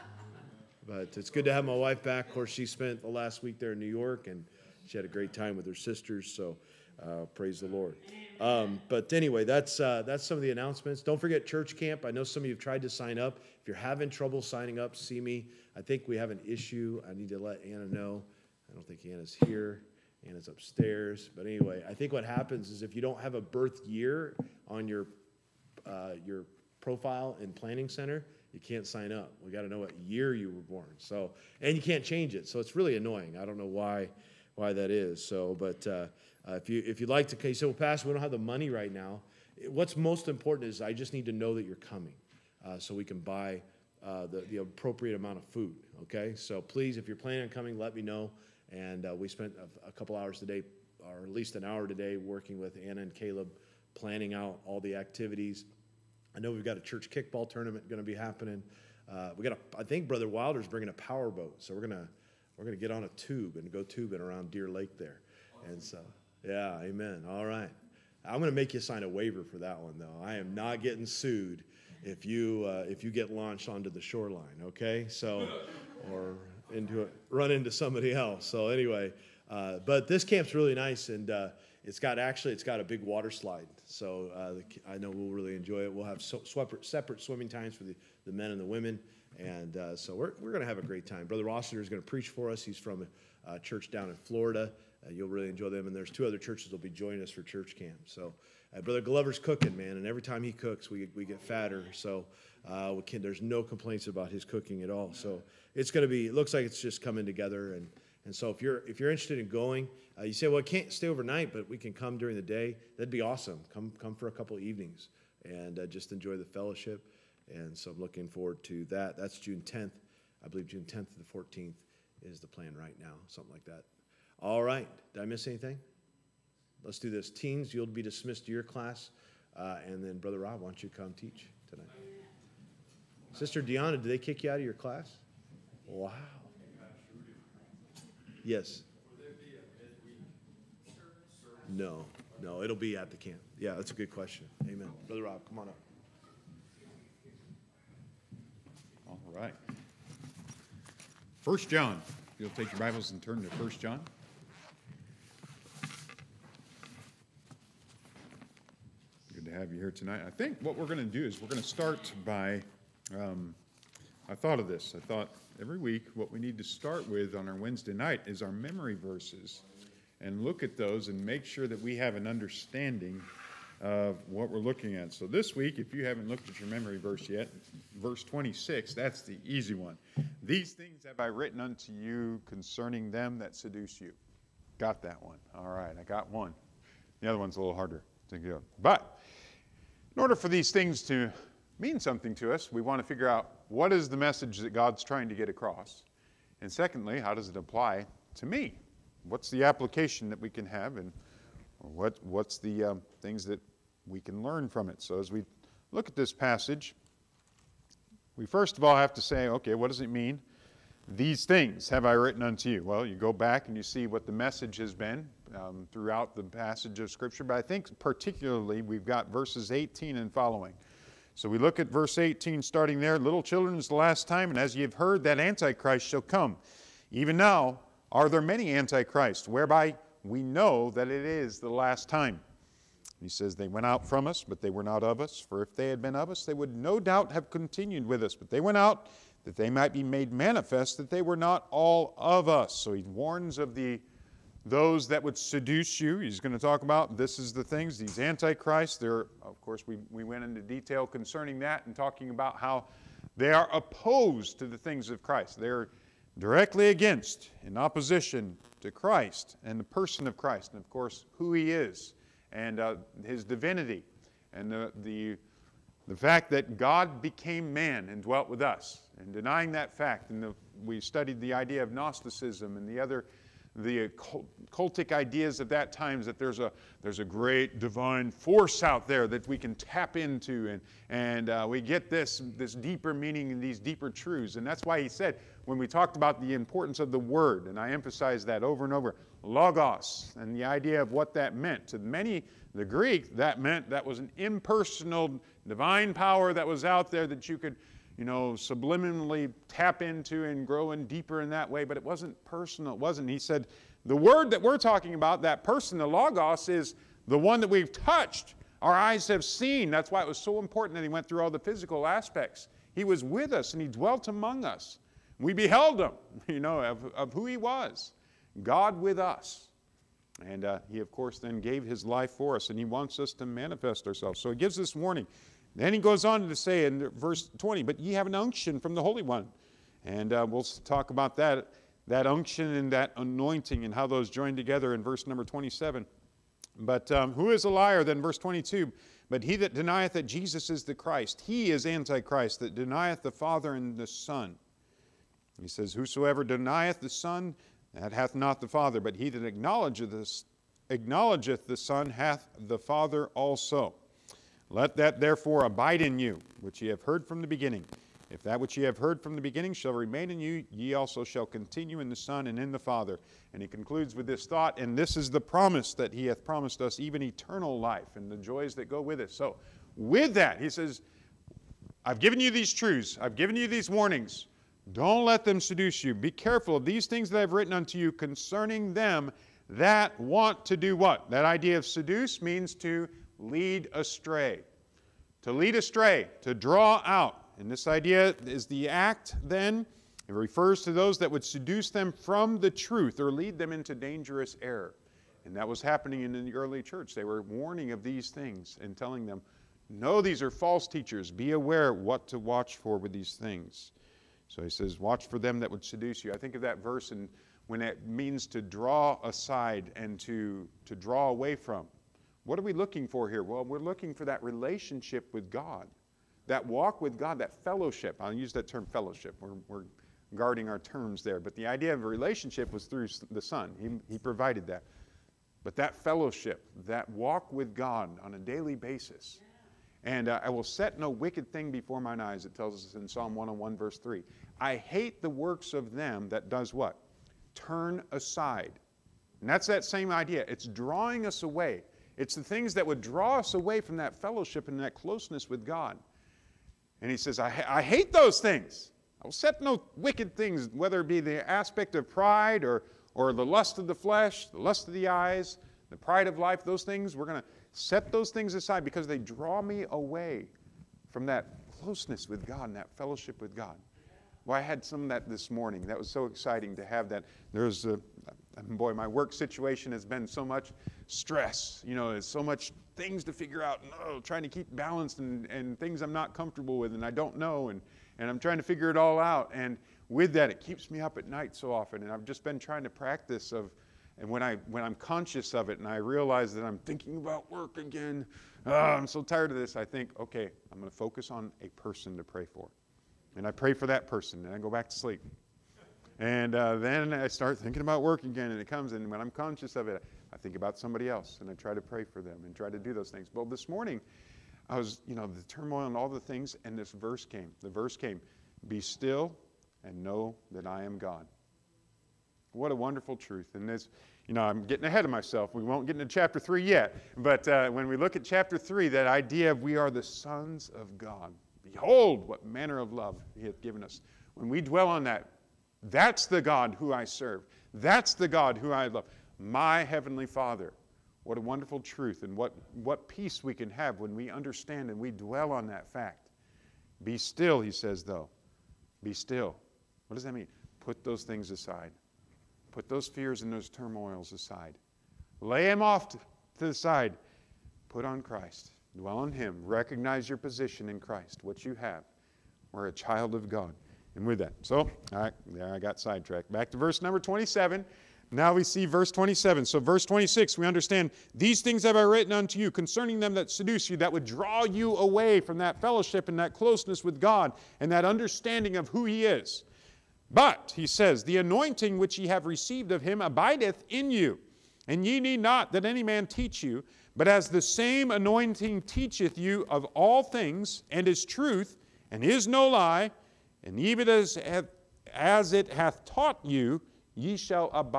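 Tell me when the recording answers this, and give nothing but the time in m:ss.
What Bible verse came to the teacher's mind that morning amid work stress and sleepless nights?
8:28.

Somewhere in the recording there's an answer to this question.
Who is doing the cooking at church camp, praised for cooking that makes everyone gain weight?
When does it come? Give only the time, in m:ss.
1:38.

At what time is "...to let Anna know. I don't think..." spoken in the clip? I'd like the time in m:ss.
0:17.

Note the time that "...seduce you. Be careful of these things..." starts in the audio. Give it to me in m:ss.
6:15.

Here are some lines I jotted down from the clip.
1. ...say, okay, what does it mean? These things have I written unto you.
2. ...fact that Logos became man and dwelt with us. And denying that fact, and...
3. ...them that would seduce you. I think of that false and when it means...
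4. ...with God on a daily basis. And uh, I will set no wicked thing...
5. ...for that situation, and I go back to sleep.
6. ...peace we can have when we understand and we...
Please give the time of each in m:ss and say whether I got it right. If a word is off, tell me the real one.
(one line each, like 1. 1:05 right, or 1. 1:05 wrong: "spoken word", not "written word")
1. 3:29 right
2. 4:26 wrong: "God", not "Logos"
3. 6:45 wrong: "verse", not "false"
4. 7:07 right
5. 8:13 wrong: "person", not "situation"
6. 8:53 right.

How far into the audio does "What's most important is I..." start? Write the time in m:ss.
0:39.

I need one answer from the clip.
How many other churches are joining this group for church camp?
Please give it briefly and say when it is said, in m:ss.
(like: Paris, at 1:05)
2, at 1:36.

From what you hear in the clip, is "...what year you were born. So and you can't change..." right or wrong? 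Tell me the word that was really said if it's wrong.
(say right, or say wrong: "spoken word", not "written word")
right.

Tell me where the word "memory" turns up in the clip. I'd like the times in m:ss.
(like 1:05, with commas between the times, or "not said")
2:48, 2:56.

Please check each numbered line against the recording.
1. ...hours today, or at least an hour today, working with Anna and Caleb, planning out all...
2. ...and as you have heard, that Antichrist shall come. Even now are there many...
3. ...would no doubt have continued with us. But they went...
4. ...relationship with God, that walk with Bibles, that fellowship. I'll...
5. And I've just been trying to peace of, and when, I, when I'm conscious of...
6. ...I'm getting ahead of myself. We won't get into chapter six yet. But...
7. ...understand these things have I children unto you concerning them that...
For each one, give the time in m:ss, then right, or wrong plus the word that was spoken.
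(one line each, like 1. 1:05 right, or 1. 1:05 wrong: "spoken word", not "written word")
1. 0:50 right
2. 3:44 right
3. 3:56 right
4. 6:54 wrong: "God", not "Bibles"
5. 8:02 wrong: "practice", not "peace"
6. 8:34 wrong: "three", not "six"
7. 9:20 wrong: "written", not "children".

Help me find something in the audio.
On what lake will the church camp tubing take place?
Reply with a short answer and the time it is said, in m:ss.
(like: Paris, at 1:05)
Deer Lake, at 1:04.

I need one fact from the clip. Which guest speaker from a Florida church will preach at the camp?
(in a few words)
Brother Rossiter.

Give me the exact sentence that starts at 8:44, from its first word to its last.
When we dwell on that, that's the God who I serve.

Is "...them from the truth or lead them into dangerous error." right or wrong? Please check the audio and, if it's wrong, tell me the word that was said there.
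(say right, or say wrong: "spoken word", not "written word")
right.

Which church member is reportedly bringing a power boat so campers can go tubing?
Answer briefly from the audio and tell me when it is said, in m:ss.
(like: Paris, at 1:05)
Brother Wilder, at 1:00.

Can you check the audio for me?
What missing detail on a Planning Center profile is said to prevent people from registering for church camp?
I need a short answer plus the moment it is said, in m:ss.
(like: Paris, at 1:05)
Birth year, at 0:23.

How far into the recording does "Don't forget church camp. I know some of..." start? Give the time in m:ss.
0:11.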